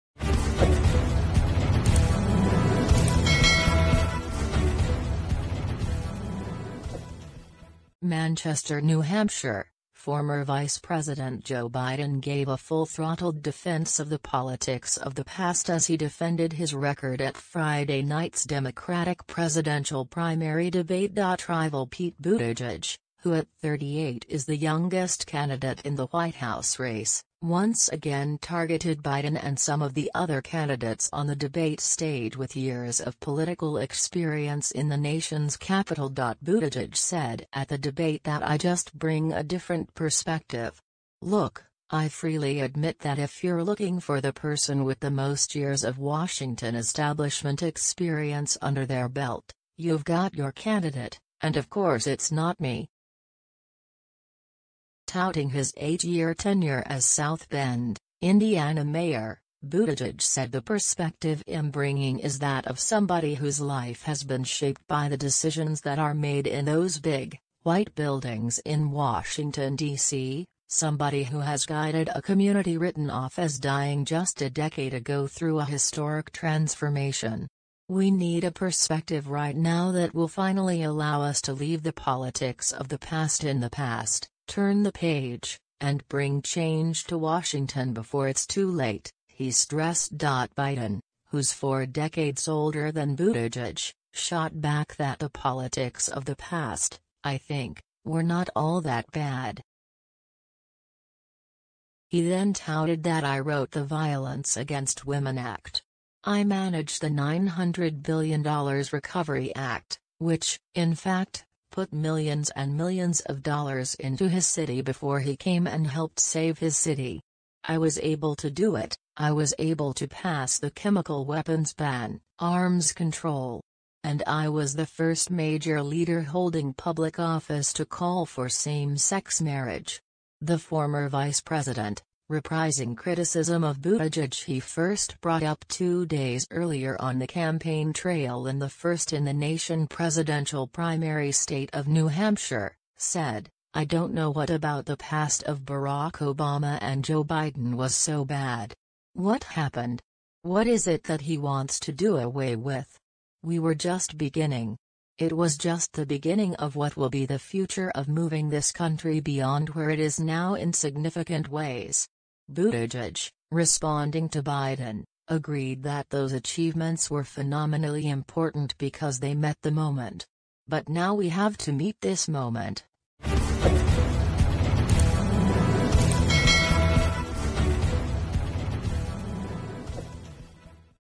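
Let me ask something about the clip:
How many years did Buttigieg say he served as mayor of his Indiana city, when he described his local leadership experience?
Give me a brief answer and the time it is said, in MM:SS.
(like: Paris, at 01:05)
8, at 00:55.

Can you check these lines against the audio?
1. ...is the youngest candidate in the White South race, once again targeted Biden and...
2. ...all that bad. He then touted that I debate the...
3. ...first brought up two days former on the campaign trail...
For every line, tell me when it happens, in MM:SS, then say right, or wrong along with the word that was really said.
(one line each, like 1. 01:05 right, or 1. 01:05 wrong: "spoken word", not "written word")
1. 00:24 wrong: "House", not "South"
2. 01:38 wrong: "wrote", not "debate"
3. 02:14 wrong: "earlier", not "former".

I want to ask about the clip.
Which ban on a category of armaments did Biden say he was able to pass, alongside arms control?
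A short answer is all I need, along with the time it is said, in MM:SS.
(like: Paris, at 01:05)
chemical weapons ban, at 02:00.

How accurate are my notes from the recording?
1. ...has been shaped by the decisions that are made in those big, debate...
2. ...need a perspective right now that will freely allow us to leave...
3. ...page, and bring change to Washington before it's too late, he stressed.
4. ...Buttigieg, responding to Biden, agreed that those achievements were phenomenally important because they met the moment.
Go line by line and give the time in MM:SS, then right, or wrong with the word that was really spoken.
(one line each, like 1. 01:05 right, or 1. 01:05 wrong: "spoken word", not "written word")
1. 01:04 wrong: "white", not "debate"
2. 01:18 wrong: "finally", not "freely"
3. 01:24 right
4. 02:42 right.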